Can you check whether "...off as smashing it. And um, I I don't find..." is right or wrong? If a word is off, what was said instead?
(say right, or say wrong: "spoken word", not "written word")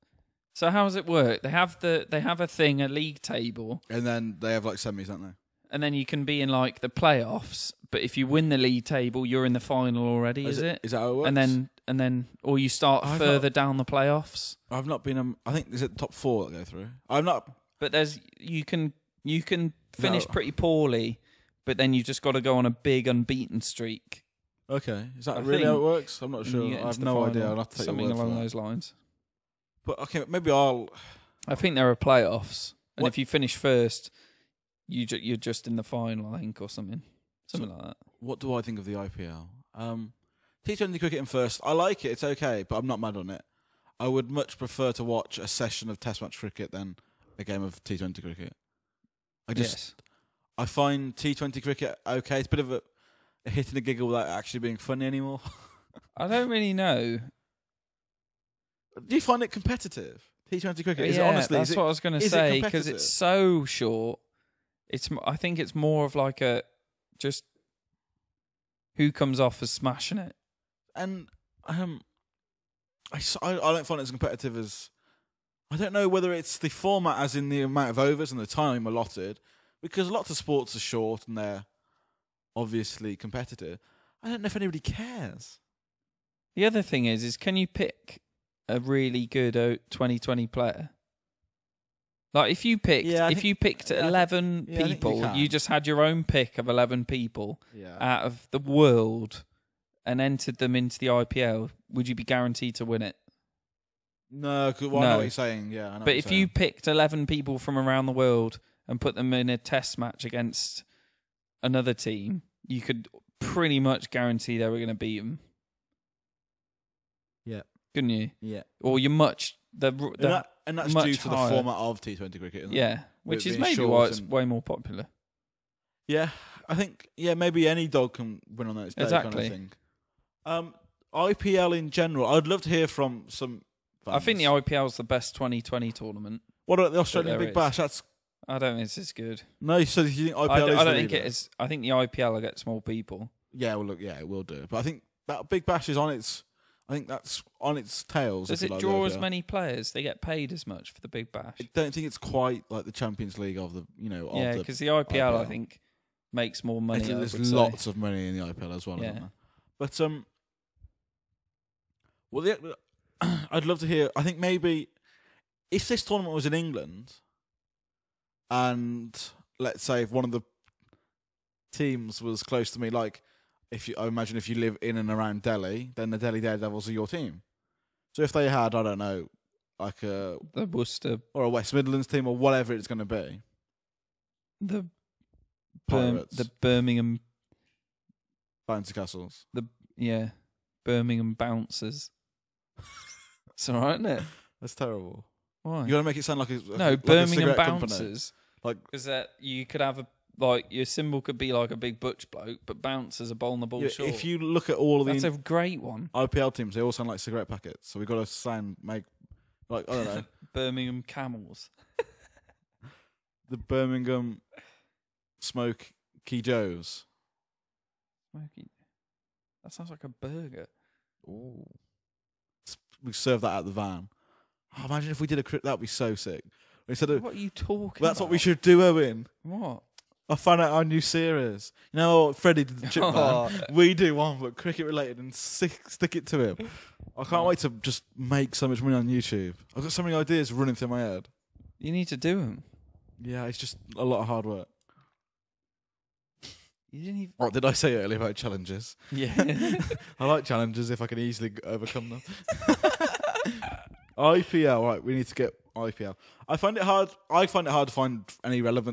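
right.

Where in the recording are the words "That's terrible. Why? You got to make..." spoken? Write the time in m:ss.
3:14.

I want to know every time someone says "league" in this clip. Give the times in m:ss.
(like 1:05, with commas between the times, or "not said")
0:02, 0:08, 2:33.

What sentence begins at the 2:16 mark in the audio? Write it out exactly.
What about the Australian Big is.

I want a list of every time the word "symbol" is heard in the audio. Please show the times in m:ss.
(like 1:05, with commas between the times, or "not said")
3:20.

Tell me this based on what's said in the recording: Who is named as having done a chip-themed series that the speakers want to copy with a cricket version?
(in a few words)
Freddie.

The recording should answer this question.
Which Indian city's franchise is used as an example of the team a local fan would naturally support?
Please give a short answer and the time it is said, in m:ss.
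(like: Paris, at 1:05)
Delhi Daredevils, at 2:56.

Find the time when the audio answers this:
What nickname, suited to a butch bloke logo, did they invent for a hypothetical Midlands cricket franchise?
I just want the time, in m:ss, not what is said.
3:10.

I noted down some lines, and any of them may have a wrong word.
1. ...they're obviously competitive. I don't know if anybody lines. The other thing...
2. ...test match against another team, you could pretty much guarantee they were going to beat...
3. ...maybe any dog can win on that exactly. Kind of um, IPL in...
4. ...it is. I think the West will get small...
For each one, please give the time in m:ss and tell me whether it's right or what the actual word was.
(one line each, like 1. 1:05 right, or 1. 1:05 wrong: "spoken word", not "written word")
1. 1:21 wrong: "cares", not "lines"
2. 1:49 right
3. 2:07 right
4. 2:21 wrong: "IPL", not "West".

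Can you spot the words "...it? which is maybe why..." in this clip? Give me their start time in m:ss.
2:02.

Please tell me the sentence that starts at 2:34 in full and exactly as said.
yeah, because the, the IPL, IPL, I think makes more money.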